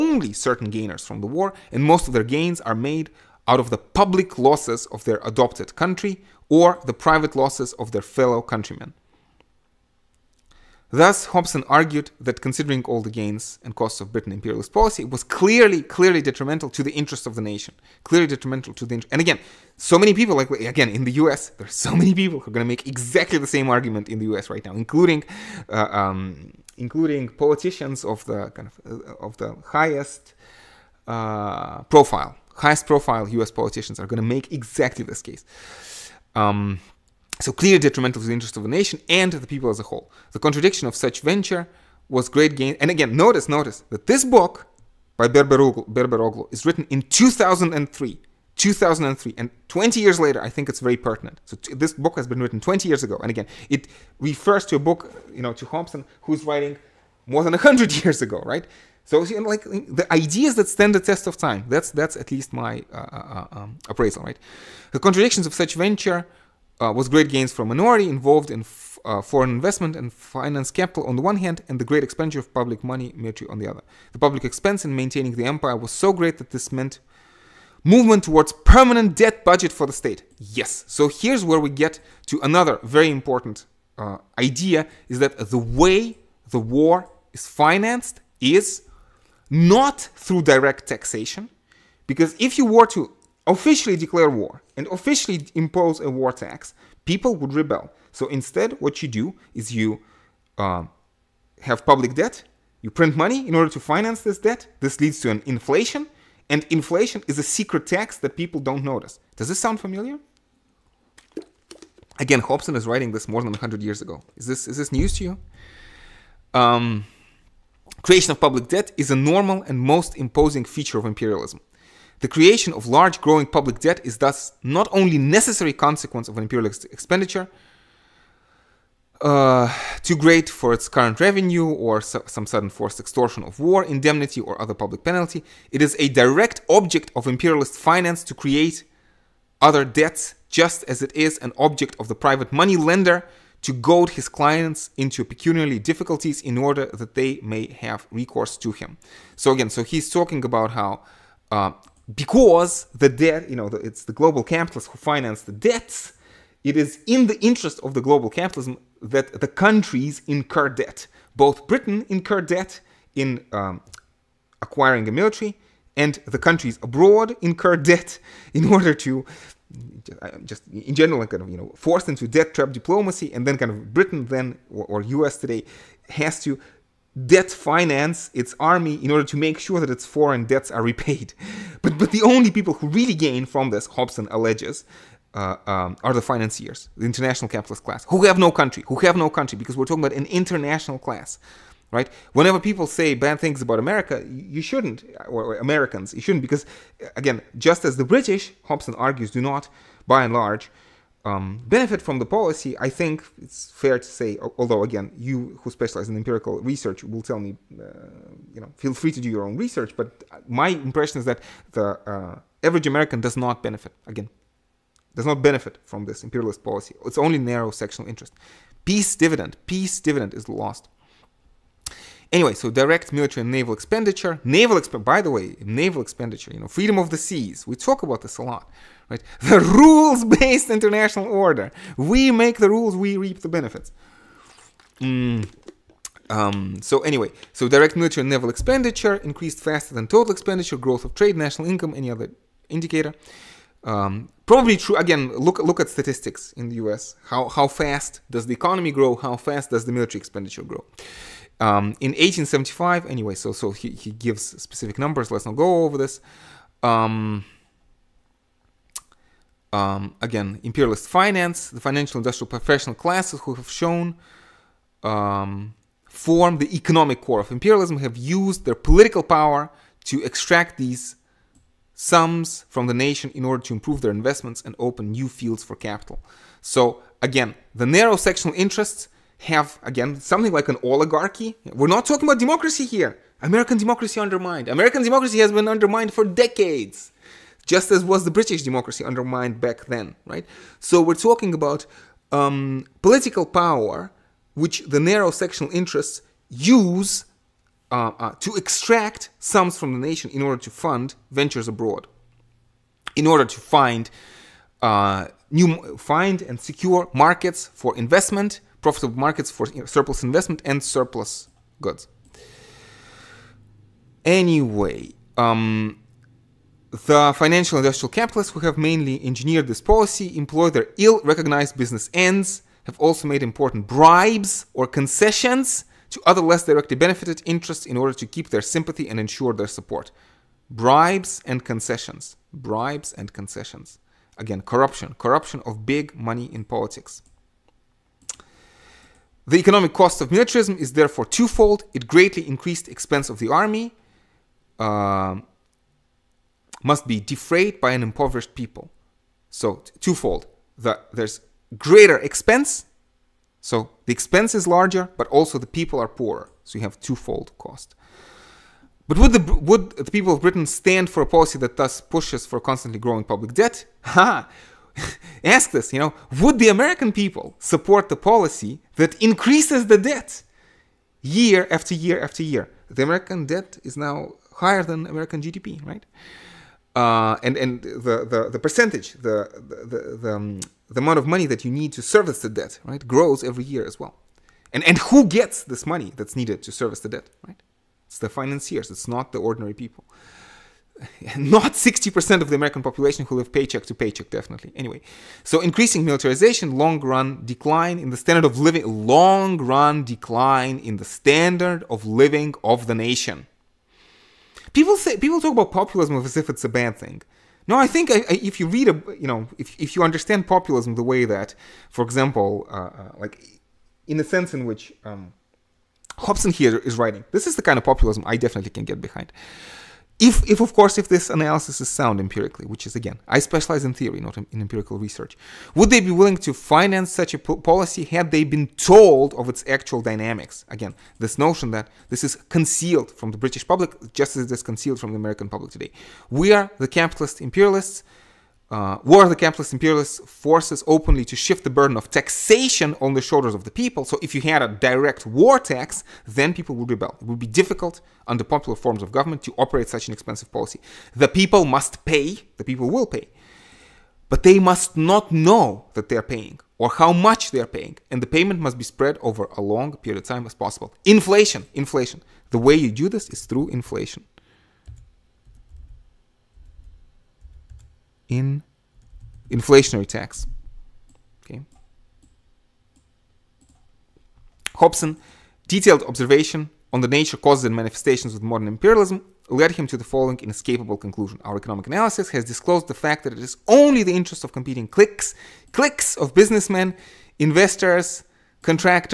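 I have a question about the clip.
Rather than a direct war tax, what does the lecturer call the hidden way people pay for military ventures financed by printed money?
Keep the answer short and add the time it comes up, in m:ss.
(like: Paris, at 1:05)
a secret tax, at 1:46.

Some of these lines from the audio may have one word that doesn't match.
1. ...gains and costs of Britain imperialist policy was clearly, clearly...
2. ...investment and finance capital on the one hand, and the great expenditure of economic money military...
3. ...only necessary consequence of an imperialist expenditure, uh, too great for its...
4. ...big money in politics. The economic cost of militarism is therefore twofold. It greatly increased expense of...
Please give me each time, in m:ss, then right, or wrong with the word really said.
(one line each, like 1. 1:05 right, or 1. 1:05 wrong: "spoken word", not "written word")
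1. 0:13 right
2. 1:09 wrong: "public", not "economic"
3. 2:04 right
4. 5:35 right.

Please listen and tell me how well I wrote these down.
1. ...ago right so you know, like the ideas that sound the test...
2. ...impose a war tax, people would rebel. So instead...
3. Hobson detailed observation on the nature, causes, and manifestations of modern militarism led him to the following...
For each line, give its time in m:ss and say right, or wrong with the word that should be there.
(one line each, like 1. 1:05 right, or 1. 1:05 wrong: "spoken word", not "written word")
1. 0:58 wrong: "stand", not "sound"
2. 1:35 right
3. 7:54 wrong: "imperialism", not "militarism".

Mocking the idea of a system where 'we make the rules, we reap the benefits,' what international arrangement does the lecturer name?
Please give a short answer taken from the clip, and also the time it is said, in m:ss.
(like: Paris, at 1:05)
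rules-based international order, at 3:49.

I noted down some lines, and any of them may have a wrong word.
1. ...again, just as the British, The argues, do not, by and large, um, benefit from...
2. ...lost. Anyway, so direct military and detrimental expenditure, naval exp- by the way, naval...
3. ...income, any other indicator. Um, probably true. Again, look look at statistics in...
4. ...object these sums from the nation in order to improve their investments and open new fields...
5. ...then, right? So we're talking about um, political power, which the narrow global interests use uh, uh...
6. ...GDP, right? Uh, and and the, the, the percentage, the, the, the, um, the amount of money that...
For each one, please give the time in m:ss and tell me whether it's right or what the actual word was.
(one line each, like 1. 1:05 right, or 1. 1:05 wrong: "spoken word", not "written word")
1. 3:17 wrong: "Hobson", not "The"
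2. 3:40 wrong: "naval", not "detrimental"
3. 4:01 right
4. 4:30 wrong: "extract", not "object"
5. 4:49 wrong: "sectional", not "global"
6. 6:15 right.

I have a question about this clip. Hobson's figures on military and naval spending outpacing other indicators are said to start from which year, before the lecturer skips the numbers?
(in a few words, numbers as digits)
1875.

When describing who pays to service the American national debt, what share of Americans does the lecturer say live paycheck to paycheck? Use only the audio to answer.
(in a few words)
60%.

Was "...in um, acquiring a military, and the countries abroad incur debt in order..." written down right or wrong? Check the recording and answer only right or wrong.
right.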